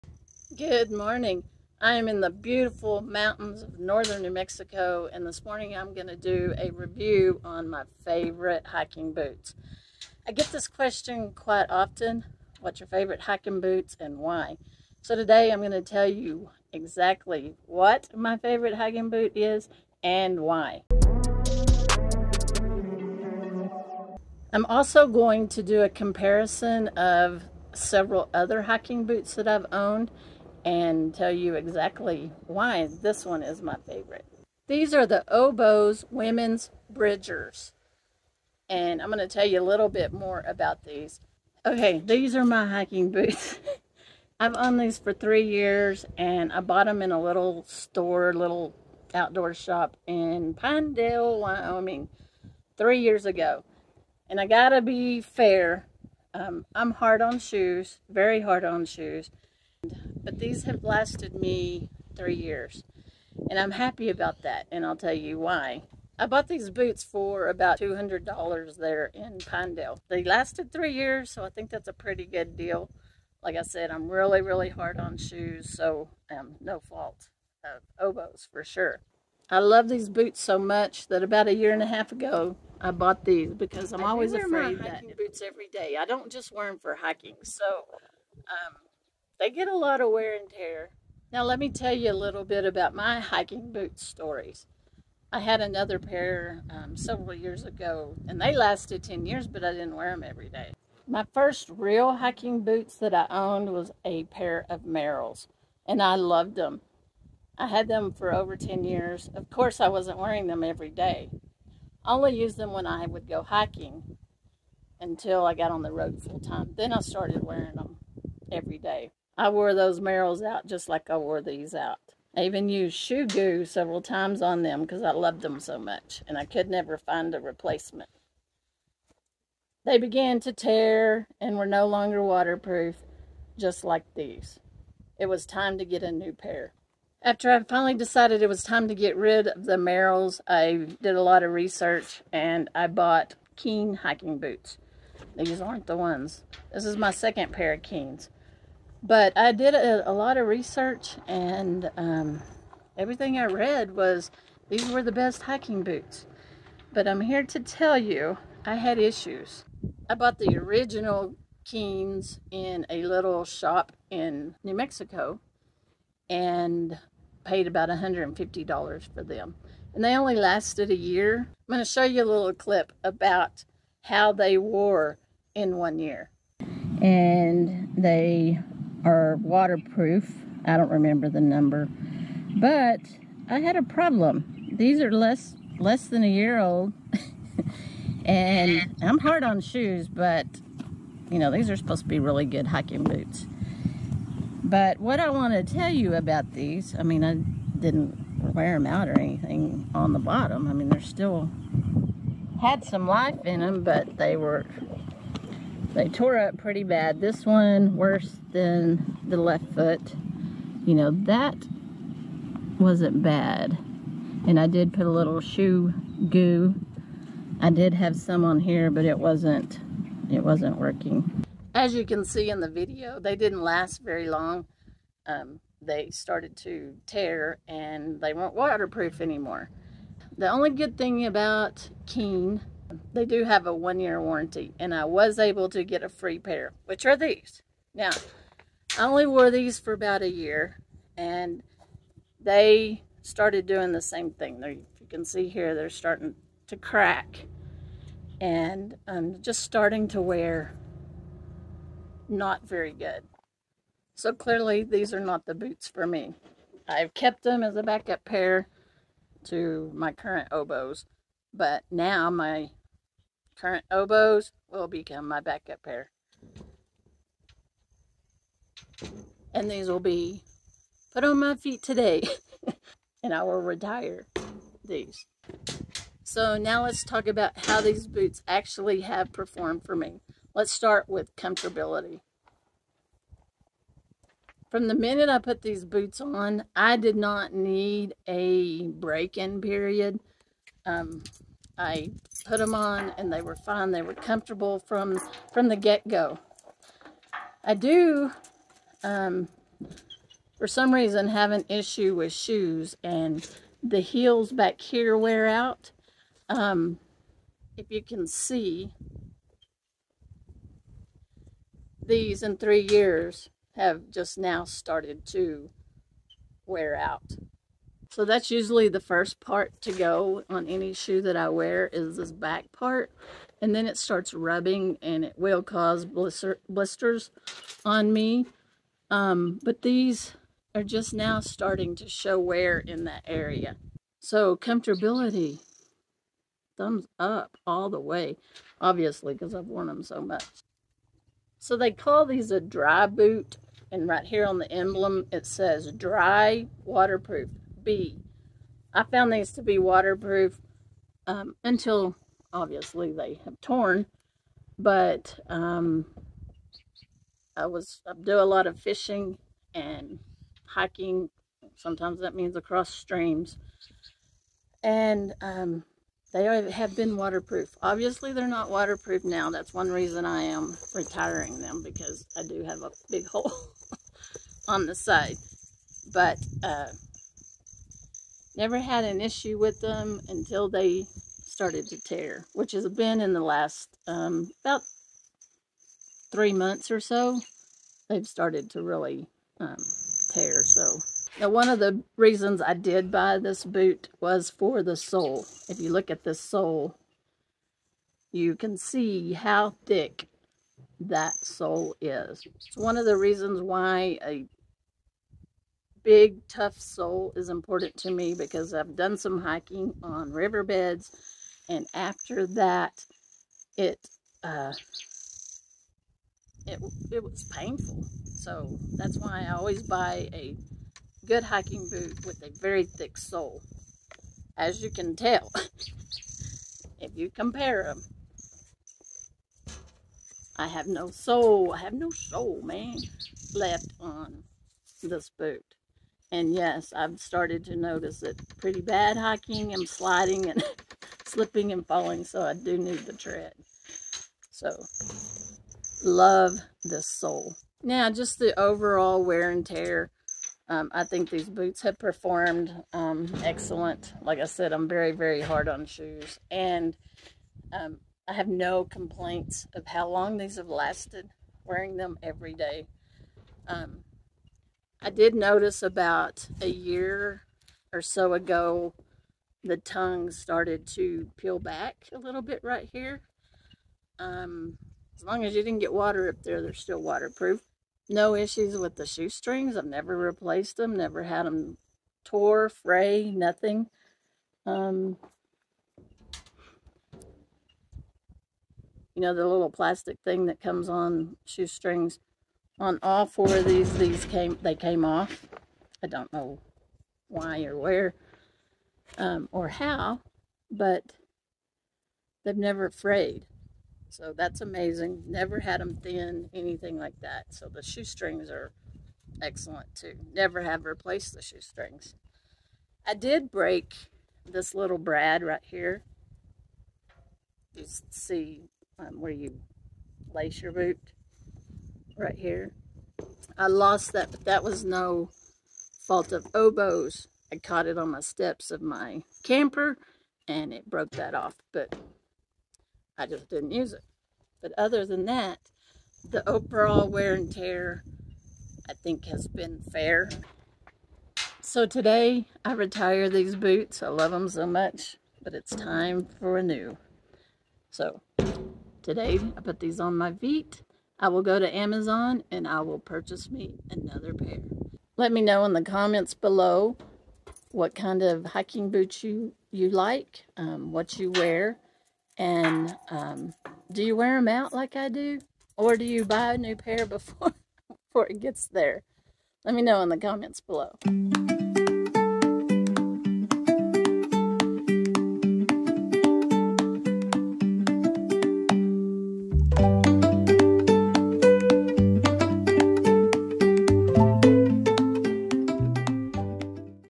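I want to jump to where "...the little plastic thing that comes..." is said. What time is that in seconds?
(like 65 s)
489 s.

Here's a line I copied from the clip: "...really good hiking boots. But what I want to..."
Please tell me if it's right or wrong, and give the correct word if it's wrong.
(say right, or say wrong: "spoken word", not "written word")
right.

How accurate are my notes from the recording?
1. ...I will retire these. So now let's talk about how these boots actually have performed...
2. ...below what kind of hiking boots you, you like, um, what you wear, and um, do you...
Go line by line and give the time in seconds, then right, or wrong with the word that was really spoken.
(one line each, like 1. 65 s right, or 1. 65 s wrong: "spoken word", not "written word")
1. 273 s right
2. 556 s right.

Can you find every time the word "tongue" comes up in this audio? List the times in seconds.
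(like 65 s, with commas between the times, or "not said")
469 s.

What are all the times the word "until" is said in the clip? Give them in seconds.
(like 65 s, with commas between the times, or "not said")
114 s, 351 s, 380 s.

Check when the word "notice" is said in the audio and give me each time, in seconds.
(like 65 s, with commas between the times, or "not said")
437 s, 465 s.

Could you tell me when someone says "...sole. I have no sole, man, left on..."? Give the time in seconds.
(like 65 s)
431 s.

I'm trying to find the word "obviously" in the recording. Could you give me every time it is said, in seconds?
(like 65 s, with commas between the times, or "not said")
338 s, 352 s, 367 s.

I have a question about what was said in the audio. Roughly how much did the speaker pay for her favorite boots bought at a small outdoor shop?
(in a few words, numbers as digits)
$200.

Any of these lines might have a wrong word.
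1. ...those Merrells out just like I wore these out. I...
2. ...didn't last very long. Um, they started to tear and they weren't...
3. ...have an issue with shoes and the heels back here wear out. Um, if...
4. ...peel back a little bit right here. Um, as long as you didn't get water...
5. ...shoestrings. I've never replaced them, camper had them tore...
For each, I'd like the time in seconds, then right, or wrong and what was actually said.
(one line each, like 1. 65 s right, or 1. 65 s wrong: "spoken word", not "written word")
1. 119 s right
2. 223 s right
3. 301 s right
4. 471 s right
5. 479 s wrong: "never", not "camper".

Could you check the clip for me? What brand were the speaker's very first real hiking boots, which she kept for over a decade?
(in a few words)
Merrell.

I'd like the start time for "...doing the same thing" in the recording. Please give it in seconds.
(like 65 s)
243 s.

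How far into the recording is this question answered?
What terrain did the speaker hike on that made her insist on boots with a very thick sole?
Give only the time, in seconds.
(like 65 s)
410 s.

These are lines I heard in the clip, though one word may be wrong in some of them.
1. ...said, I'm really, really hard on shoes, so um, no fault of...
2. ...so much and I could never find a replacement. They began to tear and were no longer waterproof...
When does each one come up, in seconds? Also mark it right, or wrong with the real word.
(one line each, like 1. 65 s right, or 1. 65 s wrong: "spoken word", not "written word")
1. 73 s right
2. 125 s right.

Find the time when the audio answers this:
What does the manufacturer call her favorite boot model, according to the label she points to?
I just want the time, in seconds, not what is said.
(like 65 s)
342 s.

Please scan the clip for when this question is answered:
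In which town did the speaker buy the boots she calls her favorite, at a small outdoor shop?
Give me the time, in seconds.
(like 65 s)
50 s.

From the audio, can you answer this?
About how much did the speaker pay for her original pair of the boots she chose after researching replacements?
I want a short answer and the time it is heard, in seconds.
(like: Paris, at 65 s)
$150, at 167 s.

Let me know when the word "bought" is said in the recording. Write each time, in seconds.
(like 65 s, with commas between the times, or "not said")
46 s, 66 s, 82 s, 142 s, 160 s.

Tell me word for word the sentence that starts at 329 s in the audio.
Um, but these are just now starting to show wear in that area.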